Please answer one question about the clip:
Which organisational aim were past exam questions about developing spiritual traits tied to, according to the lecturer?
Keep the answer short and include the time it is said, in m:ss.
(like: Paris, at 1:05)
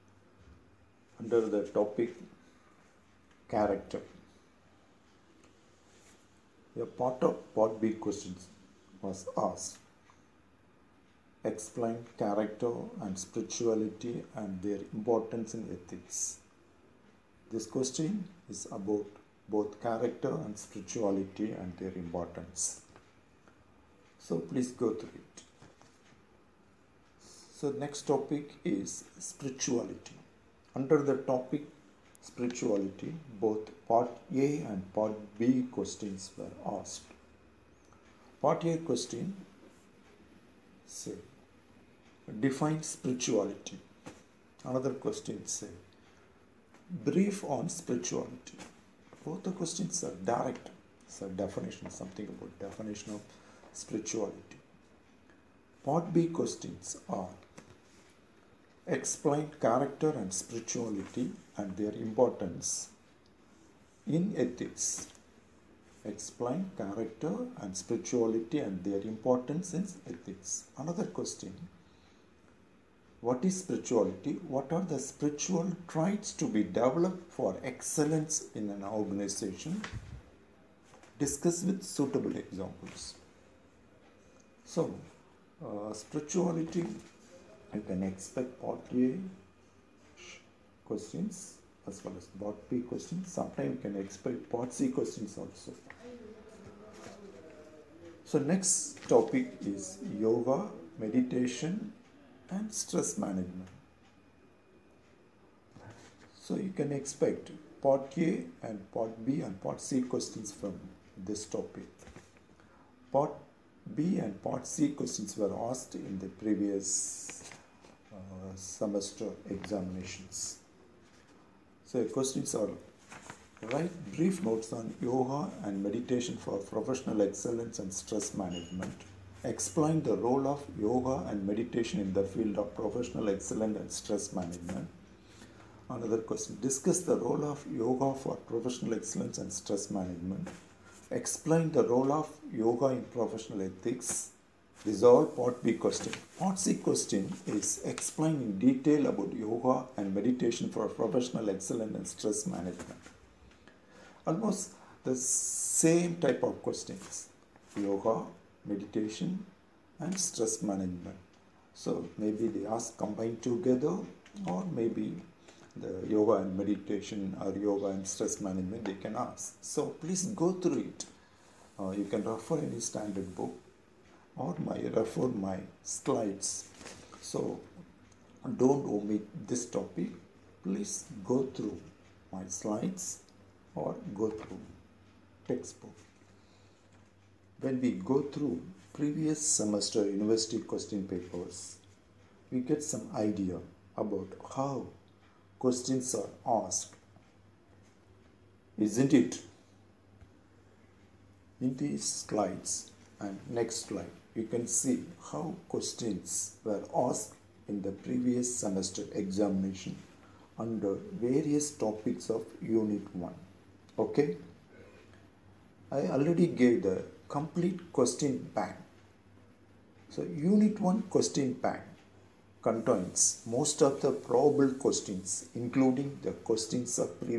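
Excellence in an organization, at 1:17.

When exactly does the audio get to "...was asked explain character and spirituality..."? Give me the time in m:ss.
0:09.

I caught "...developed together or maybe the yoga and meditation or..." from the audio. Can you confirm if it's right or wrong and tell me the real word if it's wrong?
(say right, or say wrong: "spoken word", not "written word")
wrong: "combined", not "developed".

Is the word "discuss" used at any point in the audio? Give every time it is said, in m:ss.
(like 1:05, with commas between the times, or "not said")
1:21, 2:16.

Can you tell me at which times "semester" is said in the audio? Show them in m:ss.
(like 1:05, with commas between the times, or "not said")
1:58, 3:09, 3:28.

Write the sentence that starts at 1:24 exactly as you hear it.
So, uh, spirituality, you can expect part A questions as well as part B questions.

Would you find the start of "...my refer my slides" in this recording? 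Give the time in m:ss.
2:54.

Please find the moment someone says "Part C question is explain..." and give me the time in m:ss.
2:26.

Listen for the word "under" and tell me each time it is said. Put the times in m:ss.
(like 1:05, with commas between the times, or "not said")
0:01, 0:30, 3:30.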